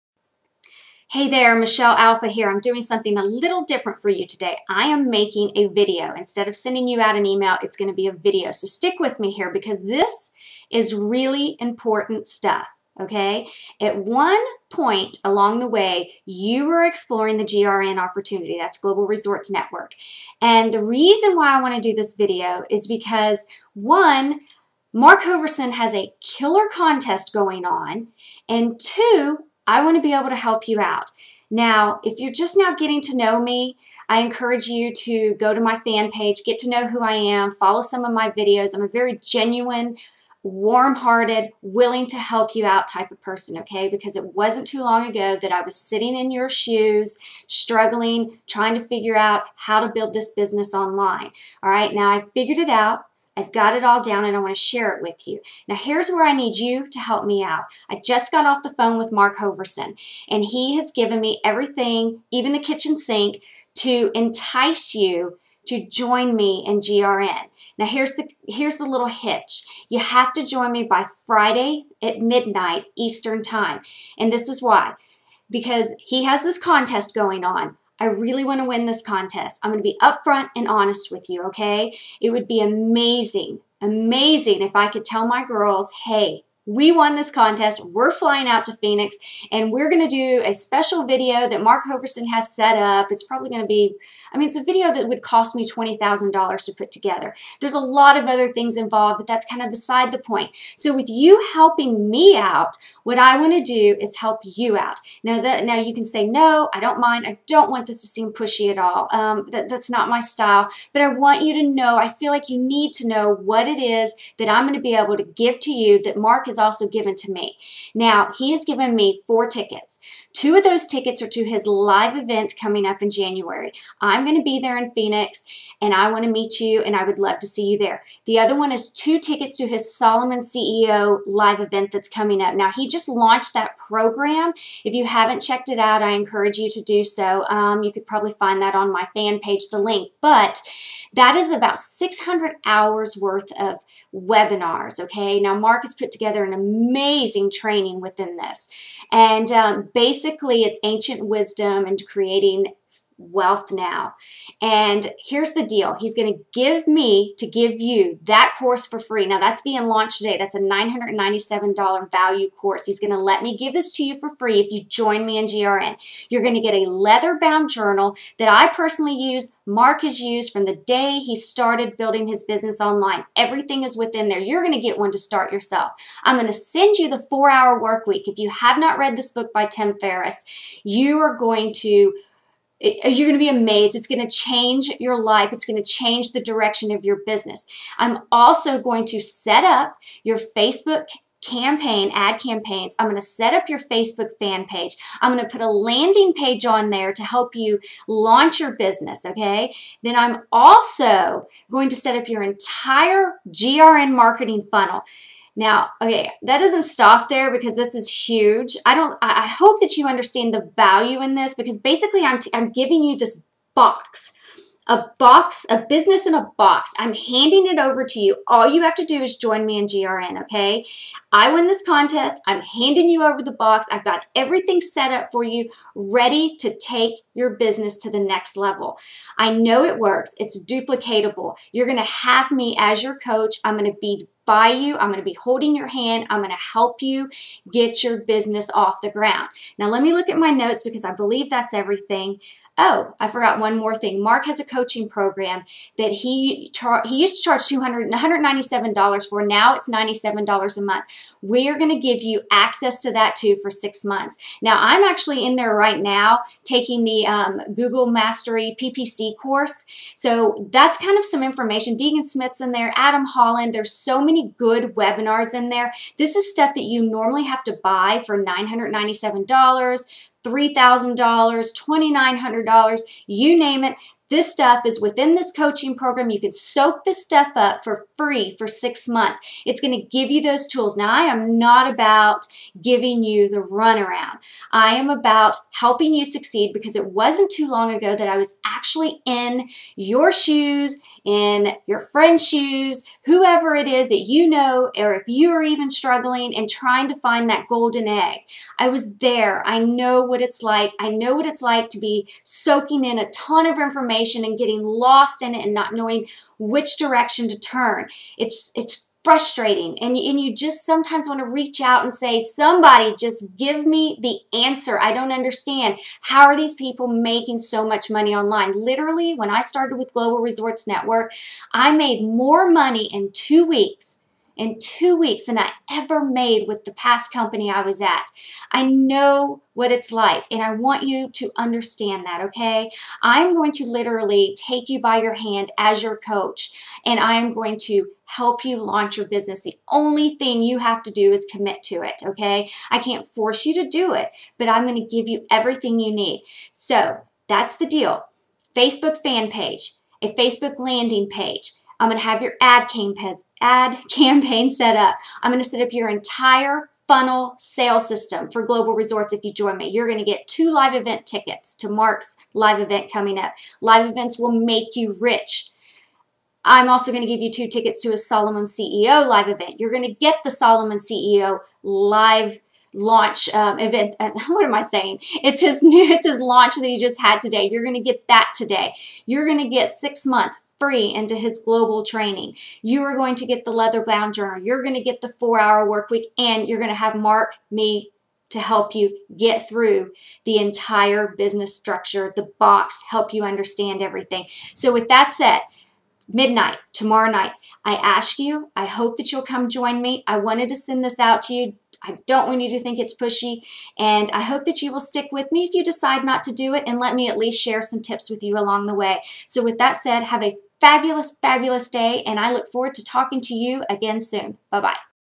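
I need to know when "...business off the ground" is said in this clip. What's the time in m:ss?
3:58.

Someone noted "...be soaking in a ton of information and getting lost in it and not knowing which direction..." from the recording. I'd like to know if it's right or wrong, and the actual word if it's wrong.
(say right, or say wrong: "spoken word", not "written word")
right.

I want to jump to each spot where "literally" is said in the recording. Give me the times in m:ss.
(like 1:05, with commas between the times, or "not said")
5:18, 5:33.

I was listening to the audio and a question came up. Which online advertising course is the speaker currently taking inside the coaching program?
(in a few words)
Google Mastery PPC.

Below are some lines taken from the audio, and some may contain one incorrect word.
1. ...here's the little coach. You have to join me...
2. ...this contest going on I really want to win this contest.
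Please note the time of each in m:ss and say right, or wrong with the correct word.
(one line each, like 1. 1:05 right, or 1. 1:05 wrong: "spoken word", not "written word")
1. 1:08 wrong: "hitch", not "coach"
2. 1:16 right.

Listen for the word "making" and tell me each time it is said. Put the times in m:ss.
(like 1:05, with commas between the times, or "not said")
0:05, 5:17.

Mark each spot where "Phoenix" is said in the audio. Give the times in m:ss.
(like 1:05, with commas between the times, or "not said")
1:28, 2:04.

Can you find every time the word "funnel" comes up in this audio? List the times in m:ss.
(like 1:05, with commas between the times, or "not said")
3:24, 5:57.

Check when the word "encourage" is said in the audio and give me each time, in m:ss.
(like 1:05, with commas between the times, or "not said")
0:34, 2:16.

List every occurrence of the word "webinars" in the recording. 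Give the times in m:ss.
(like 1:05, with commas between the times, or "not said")
2:24, 4:24.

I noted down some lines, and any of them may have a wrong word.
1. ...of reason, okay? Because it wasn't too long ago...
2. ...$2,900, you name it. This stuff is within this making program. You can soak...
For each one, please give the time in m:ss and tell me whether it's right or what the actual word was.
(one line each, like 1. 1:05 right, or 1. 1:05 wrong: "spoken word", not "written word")
1. 0:43 wrong: "person", not "reason"
2. 4:31 wrong: "coaching", not "making".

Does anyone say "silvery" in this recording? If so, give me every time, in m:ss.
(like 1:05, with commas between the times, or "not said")
not said.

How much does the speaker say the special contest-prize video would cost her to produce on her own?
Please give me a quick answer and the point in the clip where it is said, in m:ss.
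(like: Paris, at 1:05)
$20,000, at 1:35.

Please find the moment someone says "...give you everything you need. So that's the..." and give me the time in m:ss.
5:45.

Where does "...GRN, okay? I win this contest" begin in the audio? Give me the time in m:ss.
3:39.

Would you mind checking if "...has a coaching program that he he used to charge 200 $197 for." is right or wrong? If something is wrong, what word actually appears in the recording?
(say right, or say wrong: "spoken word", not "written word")
right.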